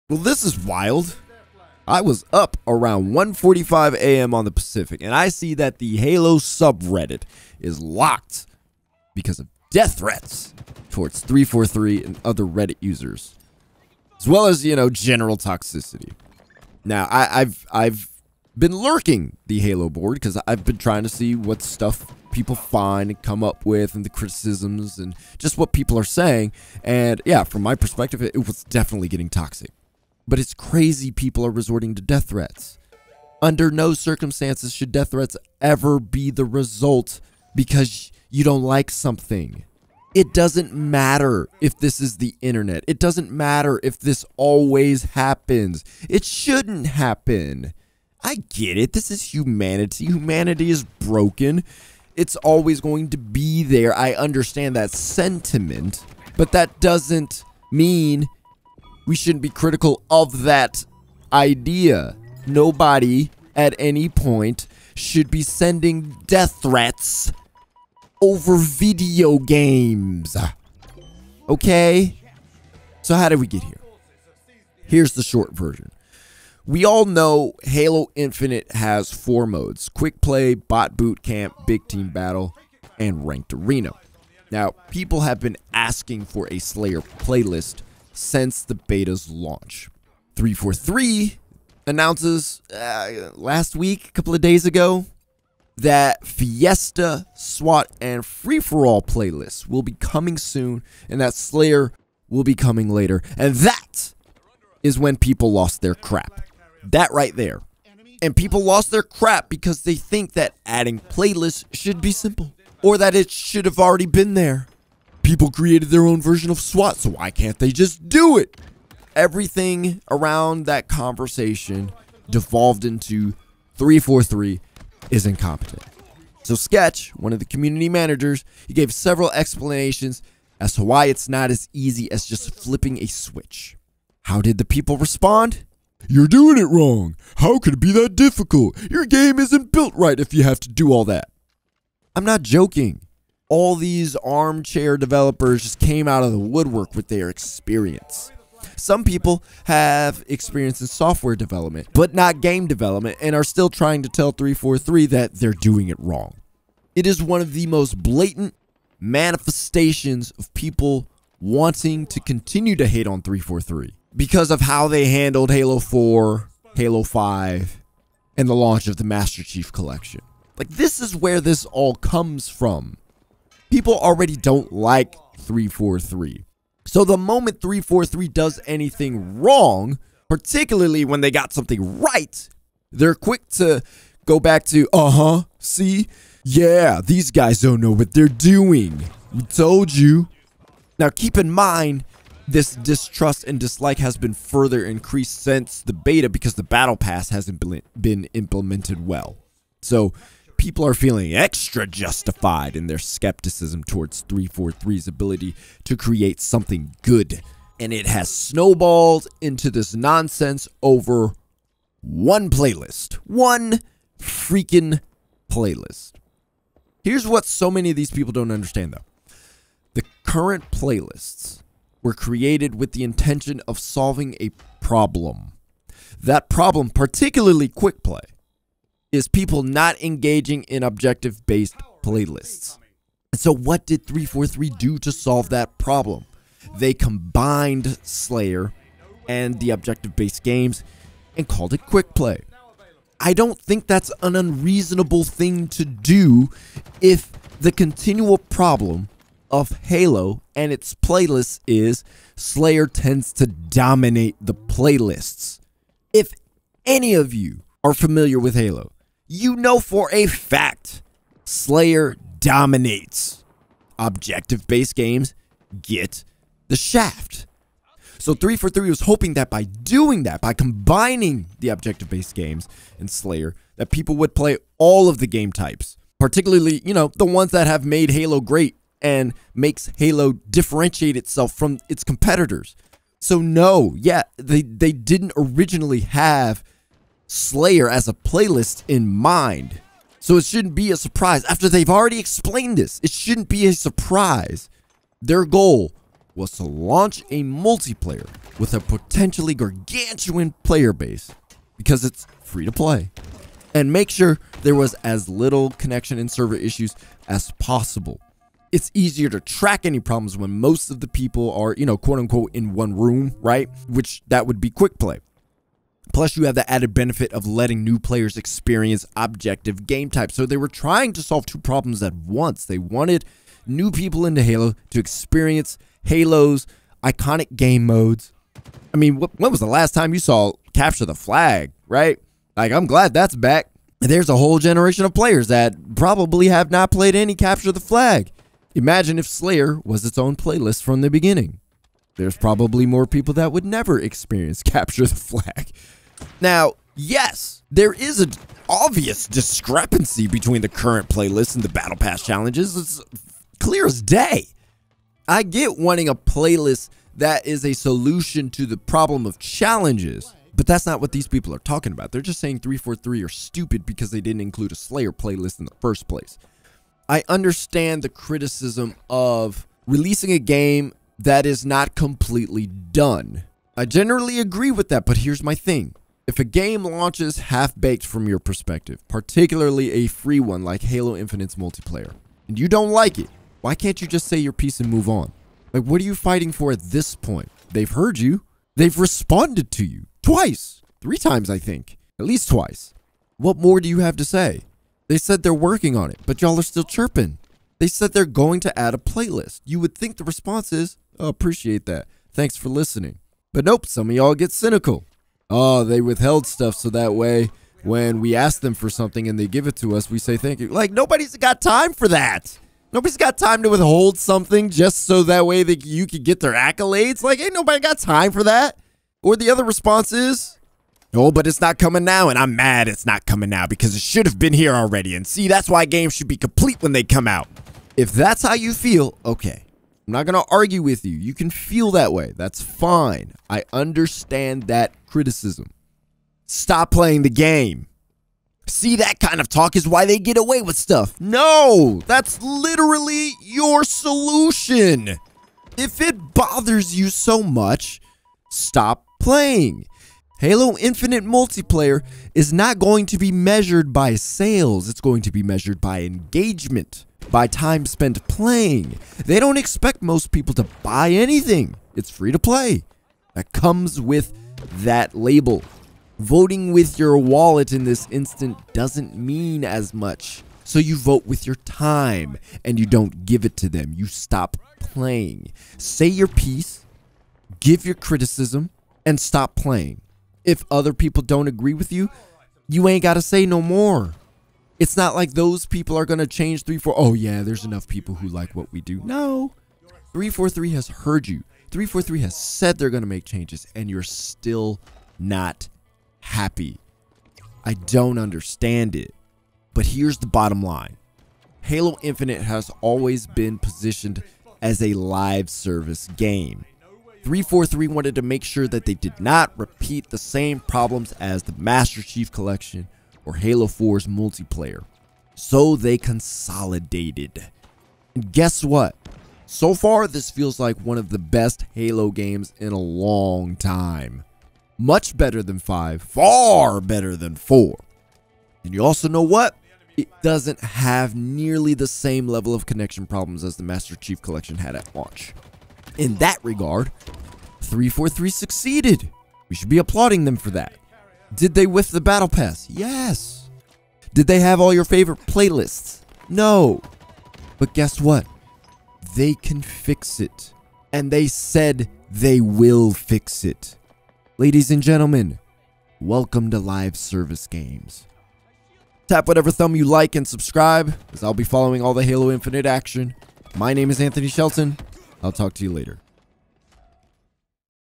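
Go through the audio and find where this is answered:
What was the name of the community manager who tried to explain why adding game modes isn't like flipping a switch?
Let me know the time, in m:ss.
2:06.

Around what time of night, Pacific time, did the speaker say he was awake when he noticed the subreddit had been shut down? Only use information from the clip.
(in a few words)
1:45 a.m.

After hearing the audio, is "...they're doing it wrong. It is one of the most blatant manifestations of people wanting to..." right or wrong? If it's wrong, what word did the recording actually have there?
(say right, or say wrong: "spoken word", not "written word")
right.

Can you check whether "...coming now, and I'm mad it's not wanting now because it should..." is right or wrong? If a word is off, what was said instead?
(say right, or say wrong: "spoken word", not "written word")
wrong: "coming", not "wanting".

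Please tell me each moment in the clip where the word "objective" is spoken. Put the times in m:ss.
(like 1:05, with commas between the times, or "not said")
3:50, 3:59, 4:23, 4:31, 5:19.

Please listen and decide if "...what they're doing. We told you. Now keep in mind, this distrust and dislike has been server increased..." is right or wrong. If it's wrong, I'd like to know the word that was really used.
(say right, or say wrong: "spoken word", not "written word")
wrong: "further", not "server".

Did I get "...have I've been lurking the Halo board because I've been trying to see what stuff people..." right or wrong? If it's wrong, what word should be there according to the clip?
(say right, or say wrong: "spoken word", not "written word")
right.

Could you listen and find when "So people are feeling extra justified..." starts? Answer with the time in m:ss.
3:19.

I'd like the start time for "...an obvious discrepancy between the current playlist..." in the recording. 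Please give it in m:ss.
5:48.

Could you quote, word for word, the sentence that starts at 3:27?
And it has snowballed into this nonsense over one playlist.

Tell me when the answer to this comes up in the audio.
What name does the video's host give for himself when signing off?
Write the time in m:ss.
9:24.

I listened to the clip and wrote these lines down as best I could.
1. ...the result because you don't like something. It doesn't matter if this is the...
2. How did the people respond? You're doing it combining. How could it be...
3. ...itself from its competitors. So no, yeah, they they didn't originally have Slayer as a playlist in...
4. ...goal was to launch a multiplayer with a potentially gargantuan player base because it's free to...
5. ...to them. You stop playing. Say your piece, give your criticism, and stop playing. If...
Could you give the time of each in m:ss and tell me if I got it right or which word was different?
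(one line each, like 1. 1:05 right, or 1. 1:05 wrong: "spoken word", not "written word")
1. 0:36 right
2. 2:14 wrong: "wrong", not "combining"
3. 4:41 right
4. 4:55 right
5. 7:53 right.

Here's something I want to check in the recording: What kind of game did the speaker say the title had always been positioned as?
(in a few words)
Live service game.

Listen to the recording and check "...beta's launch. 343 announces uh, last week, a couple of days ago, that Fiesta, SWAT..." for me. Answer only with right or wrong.
right.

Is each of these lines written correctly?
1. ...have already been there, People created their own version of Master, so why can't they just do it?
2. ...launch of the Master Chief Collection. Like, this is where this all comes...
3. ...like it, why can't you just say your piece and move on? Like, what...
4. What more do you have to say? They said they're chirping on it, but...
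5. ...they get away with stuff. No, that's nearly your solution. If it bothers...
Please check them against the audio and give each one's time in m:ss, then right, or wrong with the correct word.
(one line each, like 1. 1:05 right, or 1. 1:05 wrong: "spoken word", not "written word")
1. 1:53 wrong: "SWAT", not "Master"
2. 2:48 right
3. 6:22 right
4. 6:33 wrong: "working", not "chirping"
5. 7:20 wrong: "literally", not "nearly".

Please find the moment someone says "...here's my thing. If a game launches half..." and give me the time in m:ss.
6:15.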